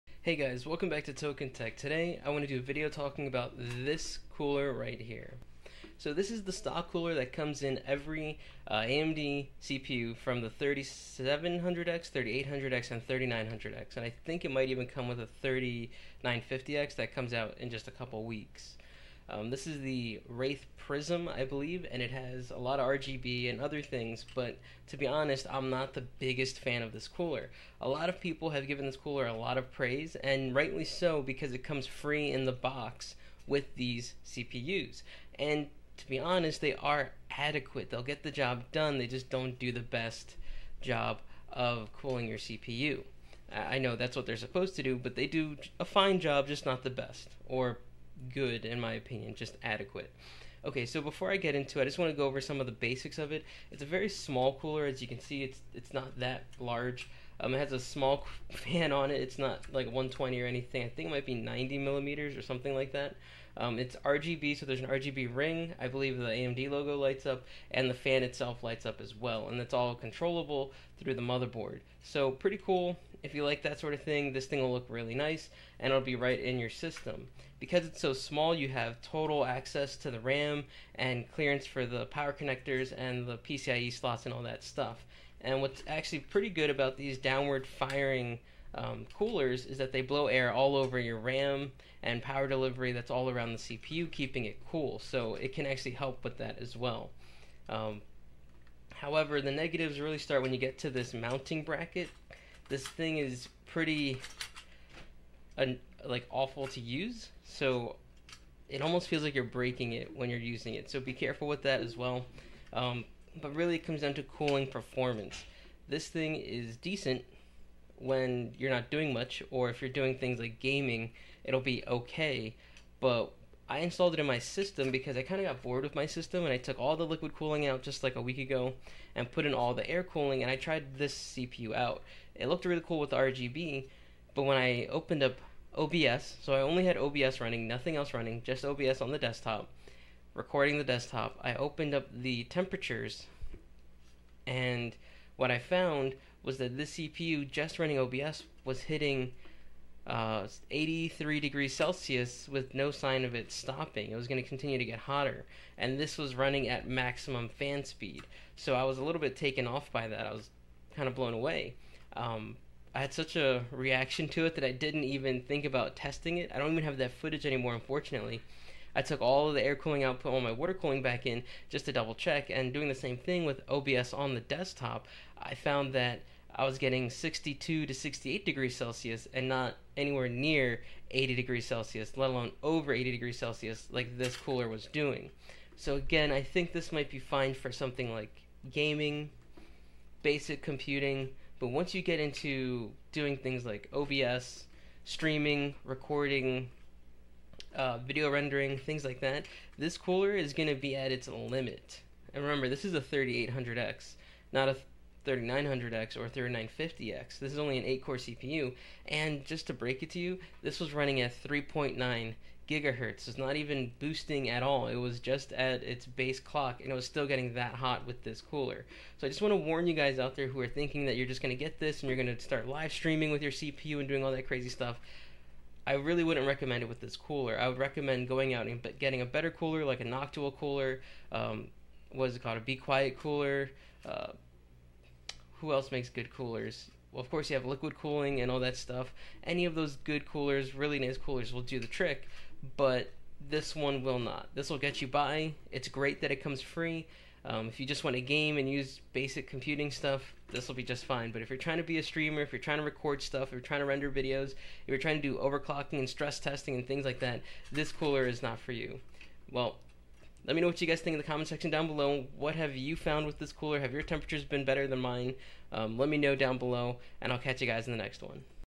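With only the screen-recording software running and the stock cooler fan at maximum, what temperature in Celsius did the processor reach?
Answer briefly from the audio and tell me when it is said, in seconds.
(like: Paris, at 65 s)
83, at 150 s.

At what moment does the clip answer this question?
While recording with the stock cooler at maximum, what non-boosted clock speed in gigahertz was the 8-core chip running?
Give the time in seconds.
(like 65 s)
211 s.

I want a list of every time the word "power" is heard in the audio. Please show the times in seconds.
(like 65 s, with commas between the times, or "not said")
82 s, 92 s.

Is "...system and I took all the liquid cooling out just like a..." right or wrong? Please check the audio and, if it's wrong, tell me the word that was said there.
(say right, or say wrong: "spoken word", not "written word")
right.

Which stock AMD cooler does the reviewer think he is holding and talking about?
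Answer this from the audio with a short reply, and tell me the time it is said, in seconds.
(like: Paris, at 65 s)
Wraith Prism, at 20 s.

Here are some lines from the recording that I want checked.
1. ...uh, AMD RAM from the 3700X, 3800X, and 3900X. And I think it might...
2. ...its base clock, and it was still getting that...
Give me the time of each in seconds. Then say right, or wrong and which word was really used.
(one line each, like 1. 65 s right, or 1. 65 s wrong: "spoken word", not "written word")
1. 8 s wrong: "CPU", not "RAM"
2. 215 s right.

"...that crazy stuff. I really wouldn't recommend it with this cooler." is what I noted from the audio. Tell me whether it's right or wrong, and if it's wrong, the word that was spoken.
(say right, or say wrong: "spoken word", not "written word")
right.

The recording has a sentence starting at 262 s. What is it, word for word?
What have you found with this cooler?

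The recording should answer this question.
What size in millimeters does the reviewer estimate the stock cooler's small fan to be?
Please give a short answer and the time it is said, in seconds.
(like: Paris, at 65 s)
90, at 61 s.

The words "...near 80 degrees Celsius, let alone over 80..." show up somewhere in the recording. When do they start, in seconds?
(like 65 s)
180 s.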